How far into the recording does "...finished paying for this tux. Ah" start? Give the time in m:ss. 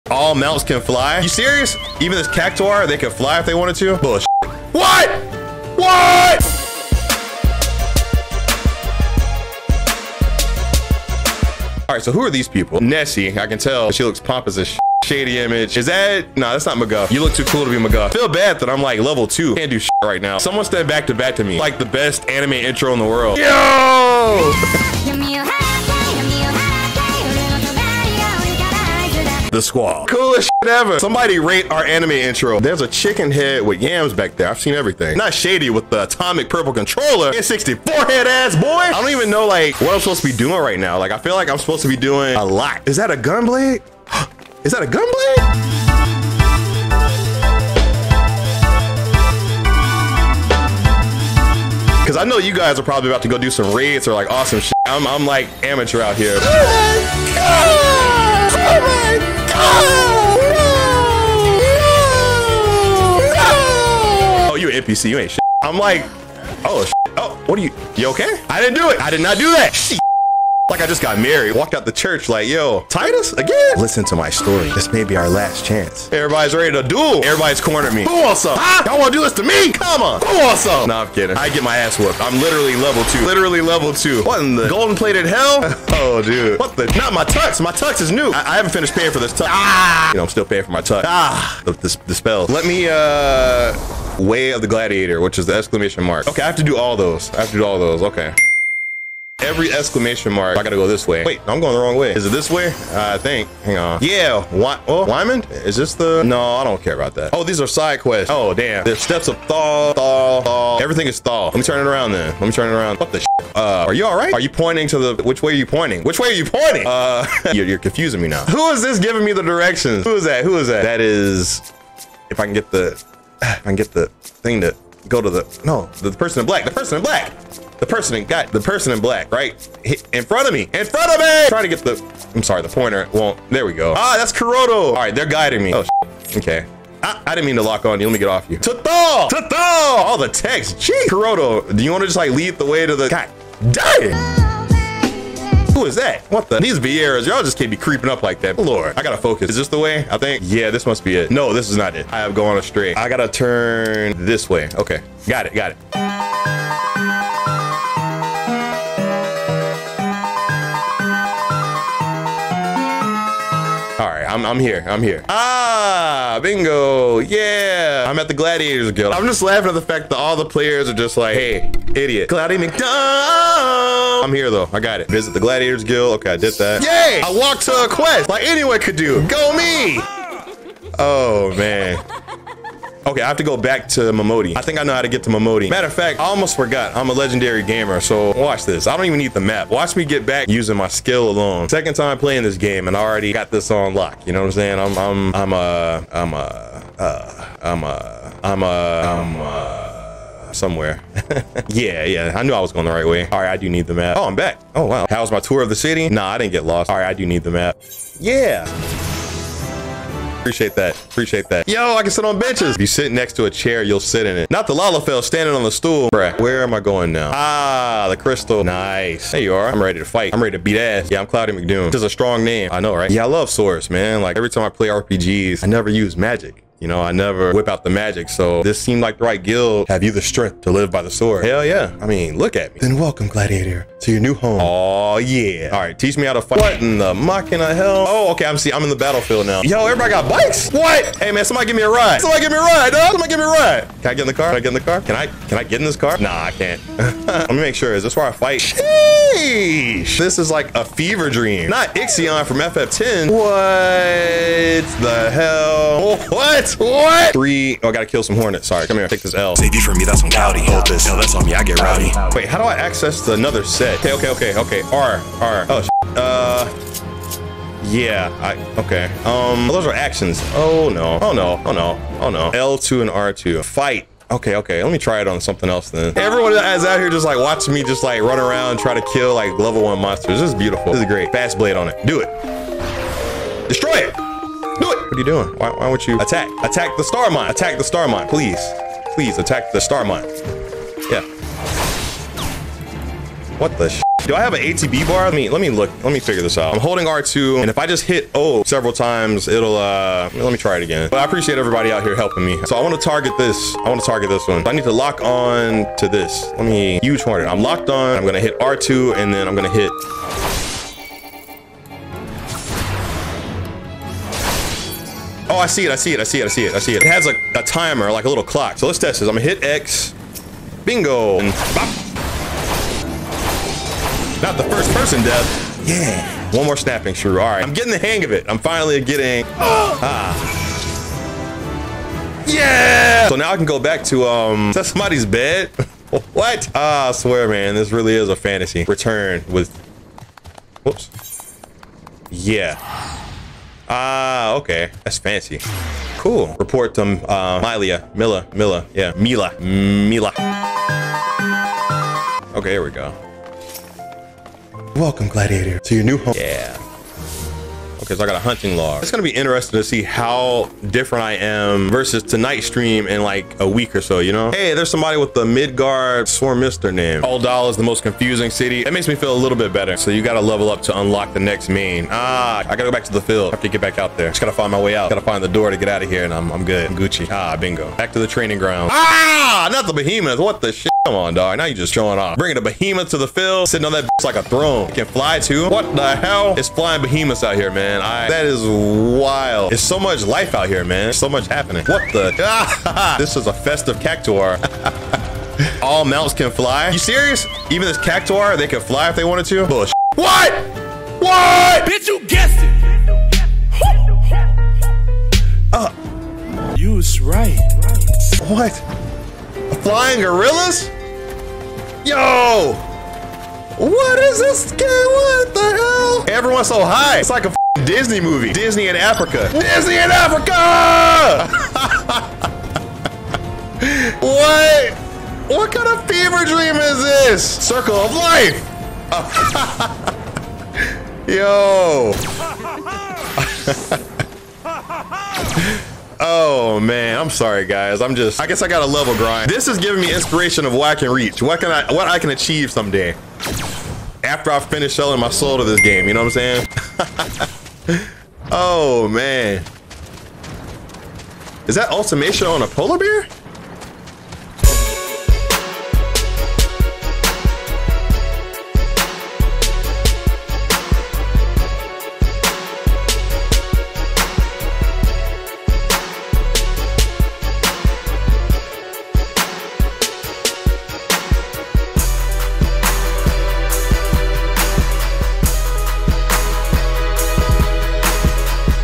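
1:28.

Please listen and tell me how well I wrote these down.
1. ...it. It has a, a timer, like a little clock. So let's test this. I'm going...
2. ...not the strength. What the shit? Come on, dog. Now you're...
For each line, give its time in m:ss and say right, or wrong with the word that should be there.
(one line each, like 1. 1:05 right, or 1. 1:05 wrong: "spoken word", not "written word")
1. 5:16 right
2. 6:19 wrong: "behemoth", not "strength".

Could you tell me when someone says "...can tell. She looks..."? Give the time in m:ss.
0:13.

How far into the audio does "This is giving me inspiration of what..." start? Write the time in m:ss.
7:19.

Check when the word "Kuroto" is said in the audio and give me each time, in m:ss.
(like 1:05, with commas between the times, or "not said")
2:14, 2:21.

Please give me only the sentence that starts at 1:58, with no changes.
Who is this giving me the directions?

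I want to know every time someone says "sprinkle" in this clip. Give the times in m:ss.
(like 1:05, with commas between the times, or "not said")
not said.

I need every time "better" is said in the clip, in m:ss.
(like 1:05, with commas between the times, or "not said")
6:09.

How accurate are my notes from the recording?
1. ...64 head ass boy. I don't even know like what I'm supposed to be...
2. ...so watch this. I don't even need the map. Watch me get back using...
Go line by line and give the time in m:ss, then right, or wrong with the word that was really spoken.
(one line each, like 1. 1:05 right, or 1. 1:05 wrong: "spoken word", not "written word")
1. 0:37 right
2. 3:07 right.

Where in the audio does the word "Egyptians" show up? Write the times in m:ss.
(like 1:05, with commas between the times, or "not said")
not said.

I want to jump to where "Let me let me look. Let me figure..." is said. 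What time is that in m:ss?
4:55.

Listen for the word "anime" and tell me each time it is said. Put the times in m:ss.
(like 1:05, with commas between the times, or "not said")
0:22, 0:31.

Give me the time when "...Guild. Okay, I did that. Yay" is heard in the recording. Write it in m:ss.
2:55.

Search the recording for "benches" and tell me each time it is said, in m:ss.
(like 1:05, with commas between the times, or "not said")
3:32.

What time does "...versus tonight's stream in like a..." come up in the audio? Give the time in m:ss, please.
6:01.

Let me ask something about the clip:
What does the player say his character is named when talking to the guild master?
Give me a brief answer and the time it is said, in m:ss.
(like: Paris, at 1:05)
Cloudie McDoom, at 3:41.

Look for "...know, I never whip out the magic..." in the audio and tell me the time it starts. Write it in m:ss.
3:46.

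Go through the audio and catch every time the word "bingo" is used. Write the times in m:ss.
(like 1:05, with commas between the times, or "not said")
2:46, 5:20, 6:17.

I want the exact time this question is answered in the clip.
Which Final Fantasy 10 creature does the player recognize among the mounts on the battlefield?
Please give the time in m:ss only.
4:11.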